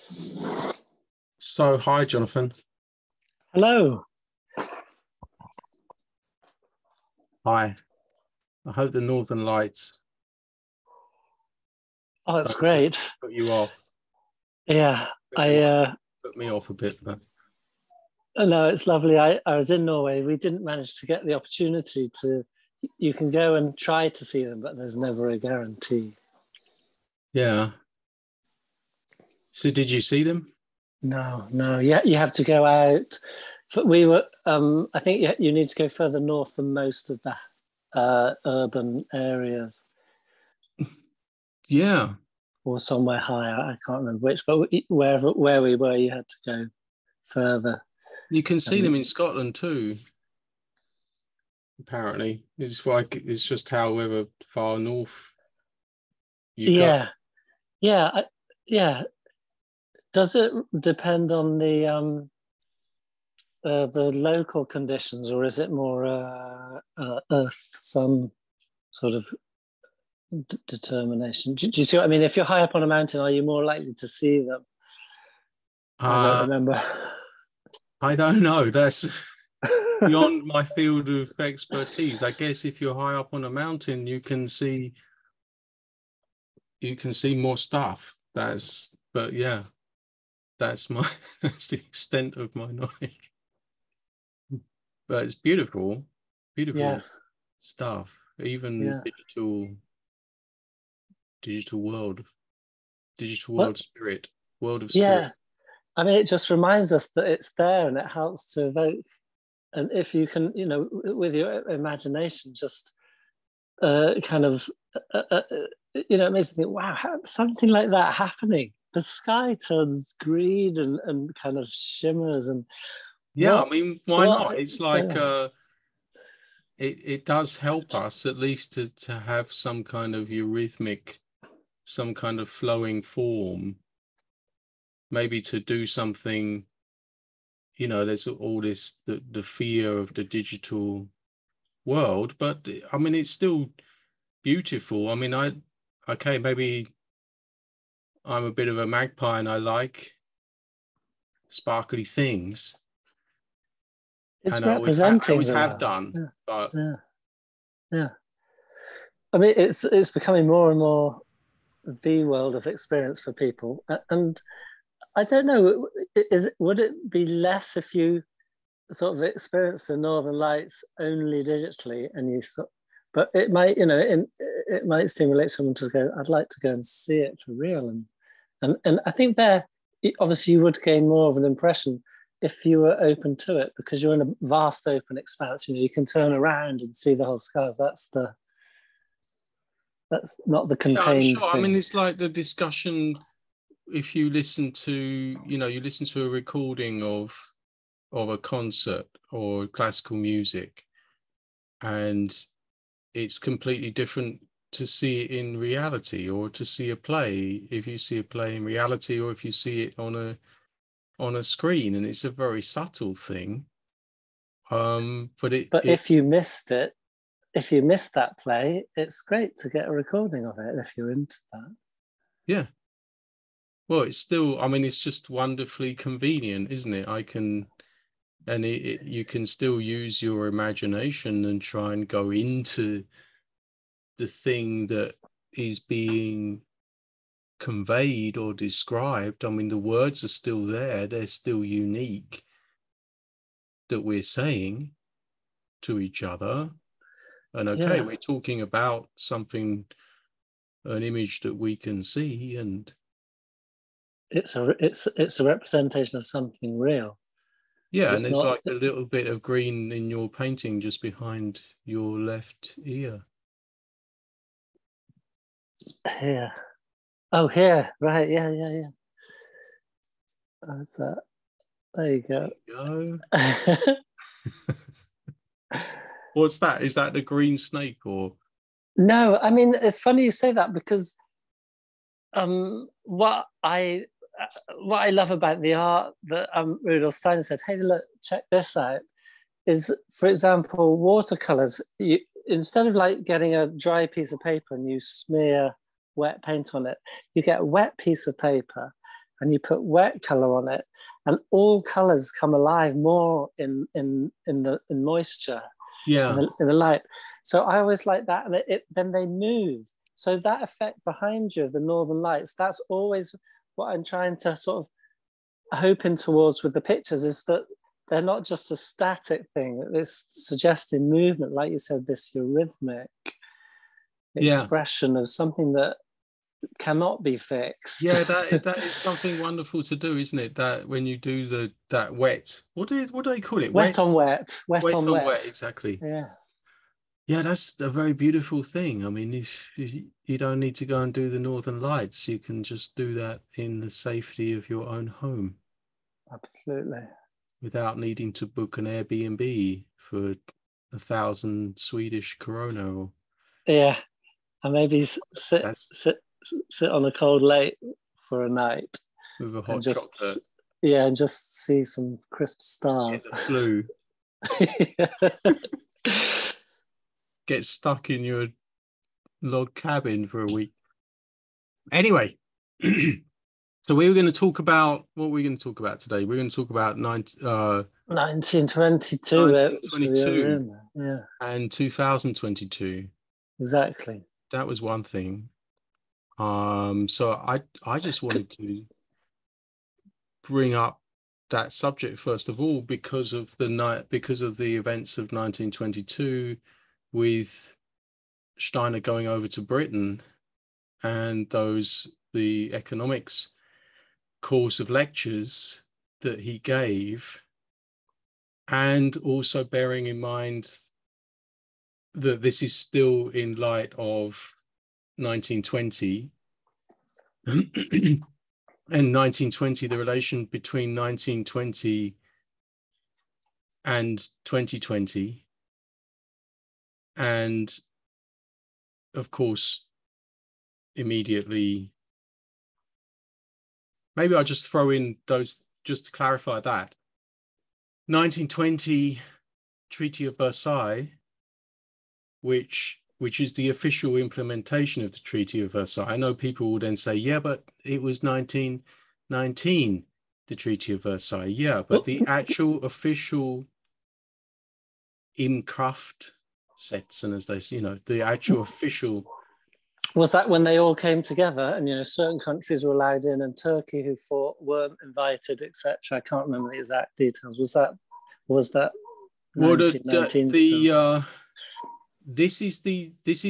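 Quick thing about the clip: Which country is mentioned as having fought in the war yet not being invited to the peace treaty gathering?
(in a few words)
Turkey.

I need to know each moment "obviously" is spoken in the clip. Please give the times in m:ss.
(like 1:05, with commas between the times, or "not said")
3:00.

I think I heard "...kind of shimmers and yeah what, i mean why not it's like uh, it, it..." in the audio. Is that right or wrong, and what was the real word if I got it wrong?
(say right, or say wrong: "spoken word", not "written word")
right.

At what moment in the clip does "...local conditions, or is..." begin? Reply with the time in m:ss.
1:04.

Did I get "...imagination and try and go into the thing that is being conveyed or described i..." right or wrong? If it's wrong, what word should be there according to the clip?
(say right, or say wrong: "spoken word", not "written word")
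right.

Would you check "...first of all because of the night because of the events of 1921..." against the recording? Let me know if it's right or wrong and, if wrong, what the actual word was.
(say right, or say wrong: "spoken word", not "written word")
wrong: "1922", not "1921".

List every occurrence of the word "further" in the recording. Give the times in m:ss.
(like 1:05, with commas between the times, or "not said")
0:35, 0:47.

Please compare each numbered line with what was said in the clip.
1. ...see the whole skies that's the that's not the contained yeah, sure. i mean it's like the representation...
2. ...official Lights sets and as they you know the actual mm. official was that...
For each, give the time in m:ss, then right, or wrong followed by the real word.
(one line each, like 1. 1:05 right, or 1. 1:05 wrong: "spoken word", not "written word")
1. 3:06 wrong: "discussion", not "representation"
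2. 7:32 wrong: "Imkraft", not "Lights".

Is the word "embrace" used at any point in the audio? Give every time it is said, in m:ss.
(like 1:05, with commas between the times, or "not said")
not said.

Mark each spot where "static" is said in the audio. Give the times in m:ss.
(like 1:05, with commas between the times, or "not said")
5:18.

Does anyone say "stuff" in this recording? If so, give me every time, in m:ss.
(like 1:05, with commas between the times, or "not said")
1:27, 1:37.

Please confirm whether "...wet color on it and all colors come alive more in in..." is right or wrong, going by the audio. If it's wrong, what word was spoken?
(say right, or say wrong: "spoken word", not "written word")
right.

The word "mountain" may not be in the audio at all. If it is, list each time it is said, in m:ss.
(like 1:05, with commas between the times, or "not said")
1:12, 1:23.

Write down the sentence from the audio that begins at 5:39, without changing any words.
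I mean, you, you don't need to go and do the Northern Lights.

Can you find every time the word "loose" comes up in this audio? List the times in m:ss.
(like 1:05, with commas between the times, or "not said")
not said.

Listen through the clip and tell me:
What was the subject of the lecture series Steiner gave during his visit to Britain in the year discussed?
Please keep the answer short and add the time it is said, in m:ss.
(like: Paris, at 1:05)
economics, at 6:42.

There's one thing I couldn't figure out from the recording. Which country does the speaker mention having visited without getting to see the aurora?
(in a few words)
Norway.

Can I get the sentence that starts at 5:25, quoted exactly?
of something that cannot be fixed.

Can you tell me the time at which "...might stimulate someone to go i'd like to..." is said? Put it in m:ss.
2:54.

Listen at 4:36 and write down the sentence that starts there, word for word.
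Is that the green snake or?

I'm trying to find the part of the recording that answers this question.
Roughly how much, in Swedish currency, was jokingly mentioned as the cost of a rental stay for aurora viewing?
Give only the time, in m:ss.
5:50.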